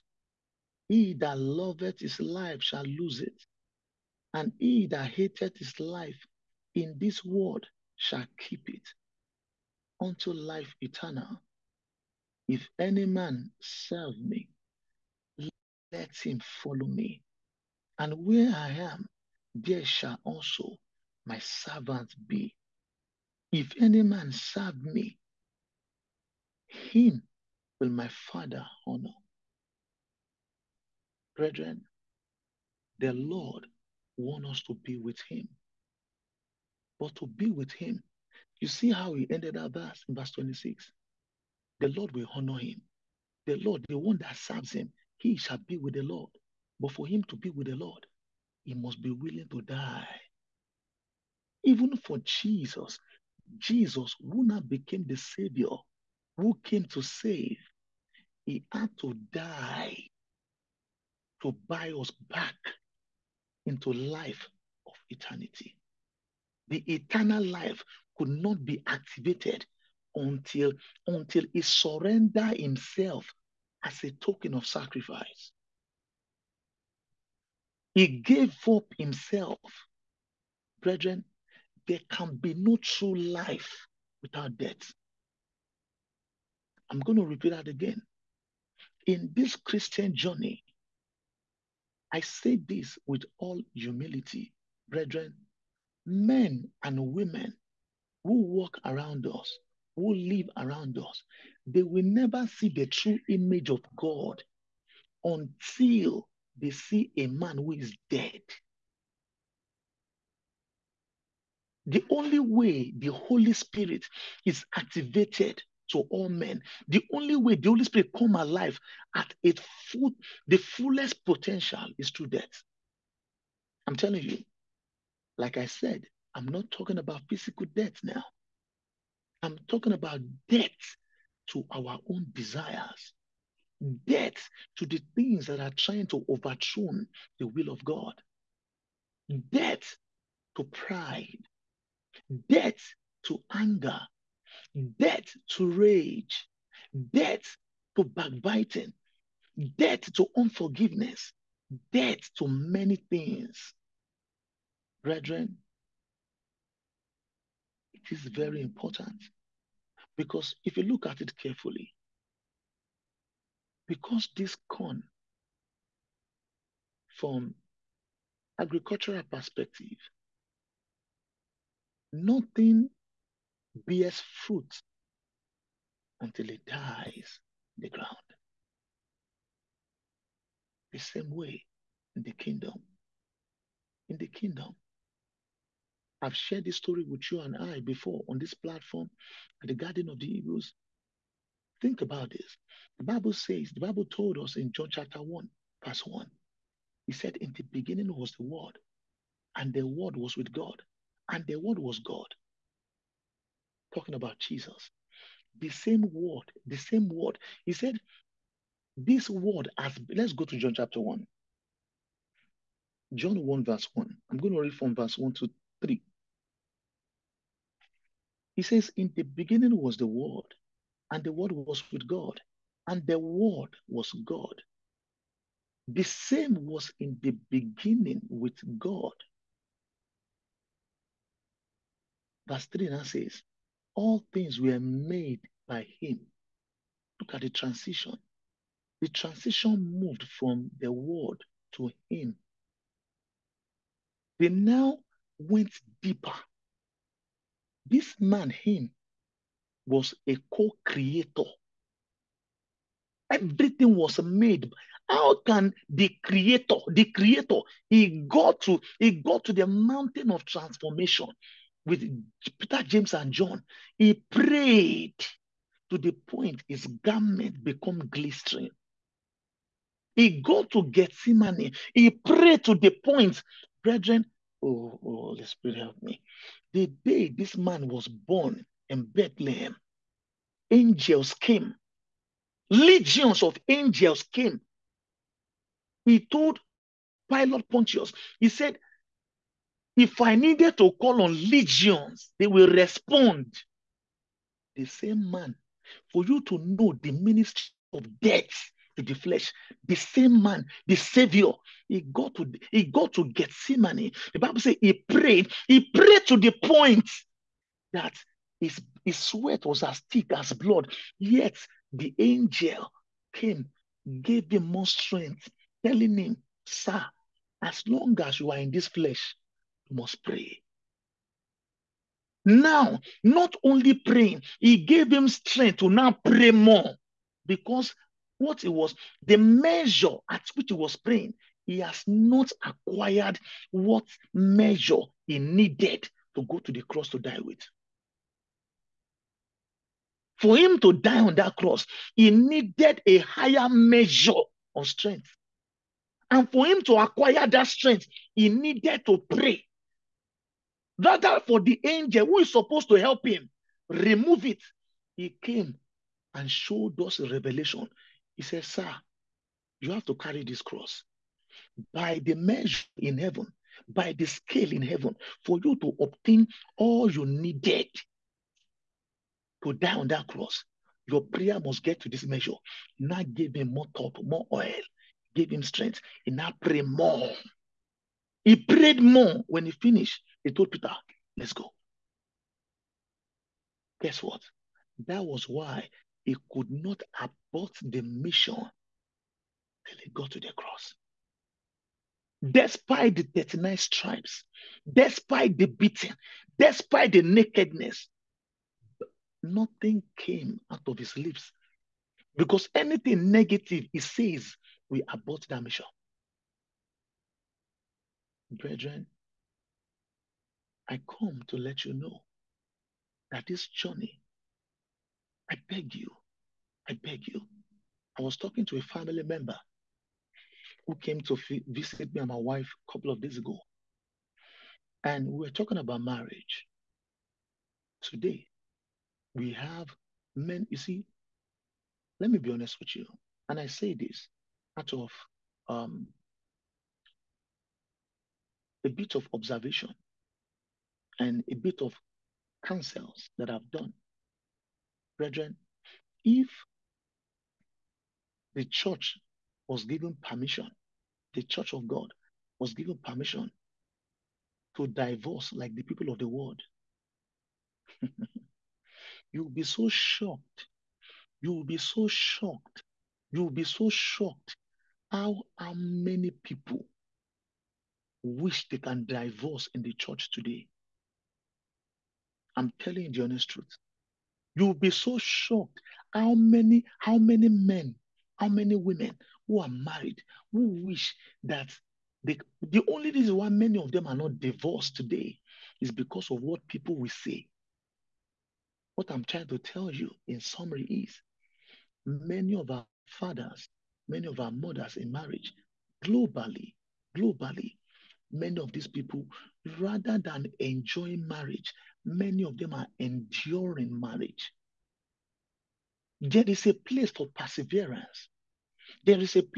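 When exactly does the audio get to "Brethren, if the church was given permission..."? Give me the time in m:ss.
7:25.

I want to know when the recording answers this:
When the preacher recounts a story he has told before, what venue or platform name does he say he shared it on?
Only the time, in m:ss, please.
3:09.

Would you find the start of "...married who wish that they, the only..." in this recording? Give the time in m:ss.
7:59.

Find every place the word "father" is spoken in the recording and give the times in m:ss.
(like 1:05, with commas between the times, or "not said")
0:28, 8:13.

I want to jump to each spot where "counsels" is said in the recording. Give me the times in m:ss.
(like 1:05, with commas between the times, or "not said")
7:22.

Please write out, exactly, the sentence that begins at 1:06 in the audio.
The eternal life could not be activated until until he surrendered himself as a token of sacrifice.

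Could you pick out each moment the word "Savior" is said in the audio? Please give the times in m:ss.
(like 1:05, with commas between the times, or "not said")
0:55, 5:00.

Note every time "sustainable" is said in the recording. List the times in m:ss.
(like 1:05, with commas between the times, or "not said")
not said.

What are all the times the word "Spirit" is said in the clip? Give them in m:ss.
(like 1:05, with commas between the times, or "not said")
1:53, 1:57, 4:35.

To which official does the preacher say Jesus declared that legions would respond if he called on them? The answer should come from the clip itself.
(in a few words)
Pilate Pontius.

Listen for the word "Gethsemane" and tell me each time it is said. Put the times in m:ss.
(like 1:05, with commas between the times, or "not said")
4:30, 5:03.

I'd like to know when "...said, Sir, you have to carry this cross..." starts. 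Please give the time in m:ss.
5:58.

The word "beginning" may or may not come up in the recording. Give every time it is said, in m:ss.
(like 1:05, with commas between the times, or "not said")
3:17, 3:39, 3:47.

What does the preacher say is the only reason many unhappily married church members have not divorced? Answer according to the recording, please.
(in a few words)
what people will say.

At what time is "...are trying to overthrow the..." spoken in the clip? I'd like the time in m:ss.
2:15.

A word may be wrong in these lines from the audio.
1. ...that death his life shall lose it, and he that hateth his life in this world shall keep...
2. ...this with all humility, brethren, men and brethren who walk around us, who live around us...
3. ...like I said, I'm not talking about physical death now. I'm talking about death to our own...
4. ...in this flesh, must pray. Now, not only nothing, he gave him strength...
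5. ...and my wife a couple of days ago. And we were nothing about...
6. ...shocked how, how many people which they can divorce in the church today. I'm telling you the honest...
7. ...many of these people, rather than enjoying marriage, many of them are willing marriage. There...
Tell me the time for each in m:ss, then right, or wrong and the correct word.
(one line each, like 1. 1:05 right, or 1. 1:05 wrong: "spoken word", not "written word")
1. 0:01 wrong: "loveth", not "death"
2. 1:32 wrong: "women", not "brethren"
3. 2:05 right
4. 5:18 wrong: "praying", not "nothing"
5. 7:02 wrong: "talking", not "nothing"
6. 7:43 right
7. 8:18 wrong: "enduring", not "willing".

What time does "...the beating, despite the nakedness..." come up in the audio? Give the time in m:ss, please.
6:35.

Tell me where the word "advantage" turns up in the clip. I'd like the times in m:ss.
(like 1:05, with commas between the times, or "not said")
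not said.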